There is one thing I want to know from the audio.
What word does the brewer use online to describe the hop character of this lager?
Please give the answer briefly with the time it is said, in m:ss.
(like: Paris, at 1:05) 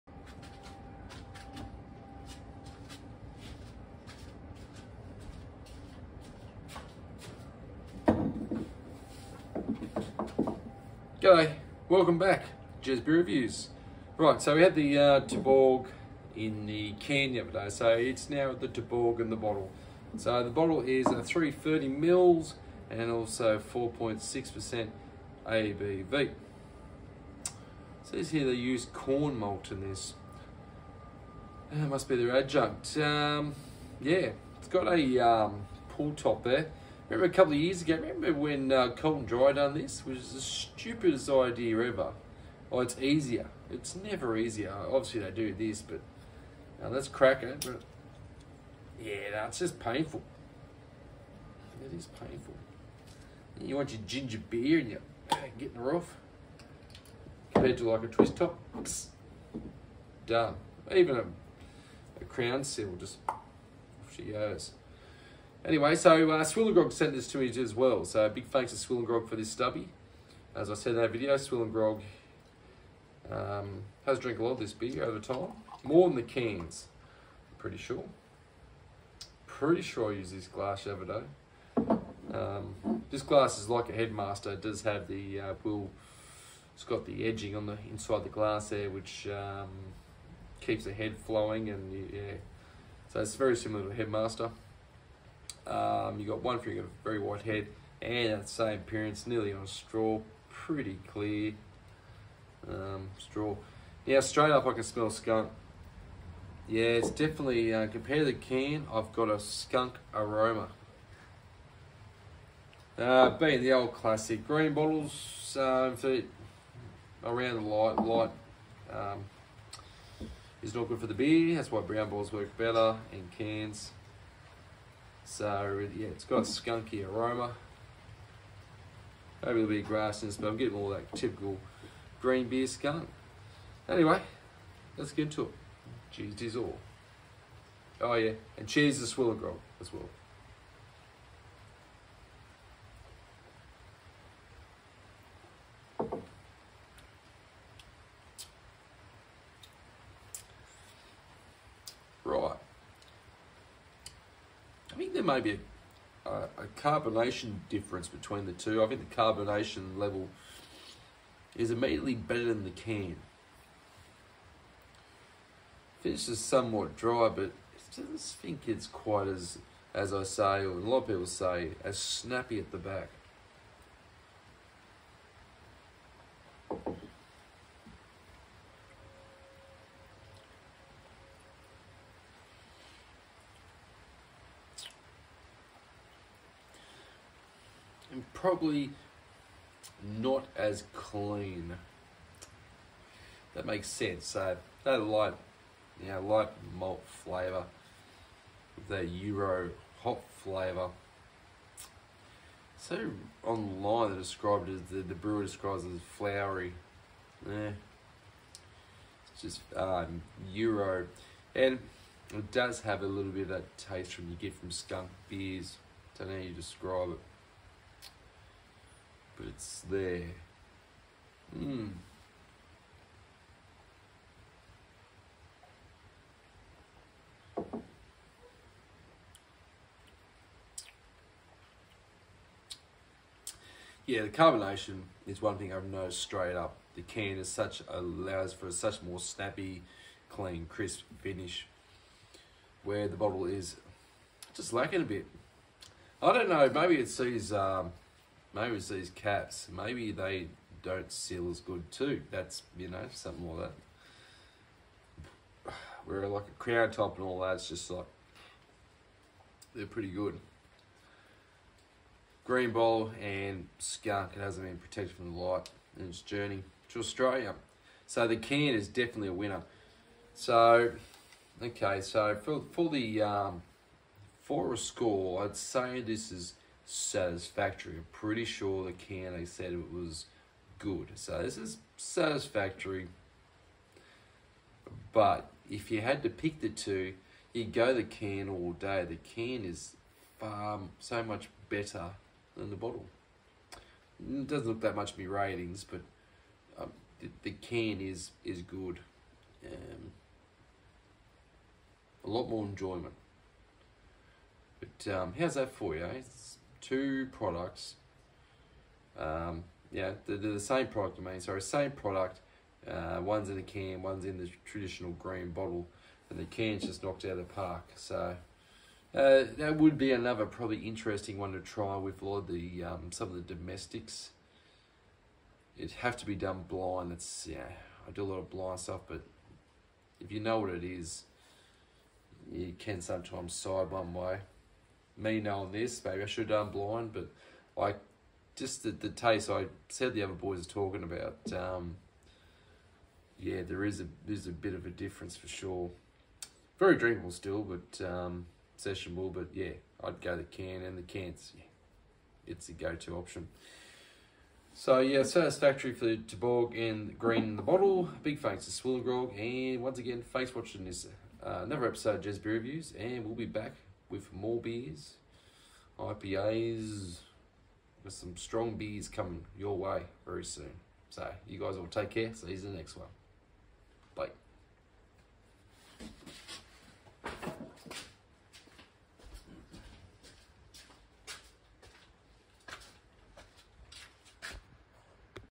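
flowery, at 3:26.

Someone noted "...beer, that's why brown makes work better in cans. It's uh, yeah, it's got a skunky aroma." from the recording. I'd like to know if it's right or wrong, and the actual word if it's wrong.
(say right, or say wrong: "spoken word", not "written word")
wrong: "bottles", not "makes".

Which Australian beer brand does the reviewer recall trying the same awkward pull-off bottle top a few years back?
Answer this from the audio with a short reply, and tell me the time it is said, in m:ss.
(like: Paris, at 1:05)
Colton Dry, at 0:38.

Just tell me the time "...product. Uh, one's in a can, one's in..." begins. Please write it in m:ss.
5:11.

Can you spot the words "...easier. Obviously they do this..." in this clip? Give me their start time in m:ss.
0:44.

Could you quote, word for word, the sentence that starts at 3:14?
So that light, you know, light malt flavour, the Euro hop flavour.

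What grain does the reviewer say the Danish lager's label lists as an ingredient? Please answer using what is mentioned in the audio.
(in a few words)
corn malt.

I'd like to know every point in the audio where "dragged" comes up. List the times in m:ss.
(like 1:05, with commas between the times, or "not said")
not said.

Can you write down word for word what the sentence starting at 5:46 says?
Very drinkable still, but um, sessionable.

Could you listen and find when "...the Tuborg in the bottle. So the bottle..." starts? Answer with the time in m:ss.
0:18.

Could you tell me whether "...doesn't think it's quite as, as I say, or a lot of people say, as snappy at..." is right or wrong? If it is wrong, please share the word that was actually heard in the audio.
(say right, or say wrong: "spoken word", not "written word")
right.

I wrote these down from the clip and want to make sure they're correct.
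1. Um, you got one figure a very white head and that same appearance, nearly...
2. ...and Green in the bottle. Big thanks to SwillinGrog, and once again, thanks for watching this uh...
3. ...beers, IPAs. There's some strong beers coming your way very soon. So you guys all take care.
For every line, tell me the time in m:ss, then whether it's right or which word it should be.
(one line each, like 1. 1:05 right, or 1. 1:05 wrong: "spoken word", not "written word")
1. 1:35 right
2. 5:56 right
3. 6:04 right.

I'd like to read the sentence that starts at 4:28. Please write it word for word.
So the can is definitely a winner.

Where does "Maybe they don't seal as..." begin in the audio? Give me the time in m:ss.
4:09.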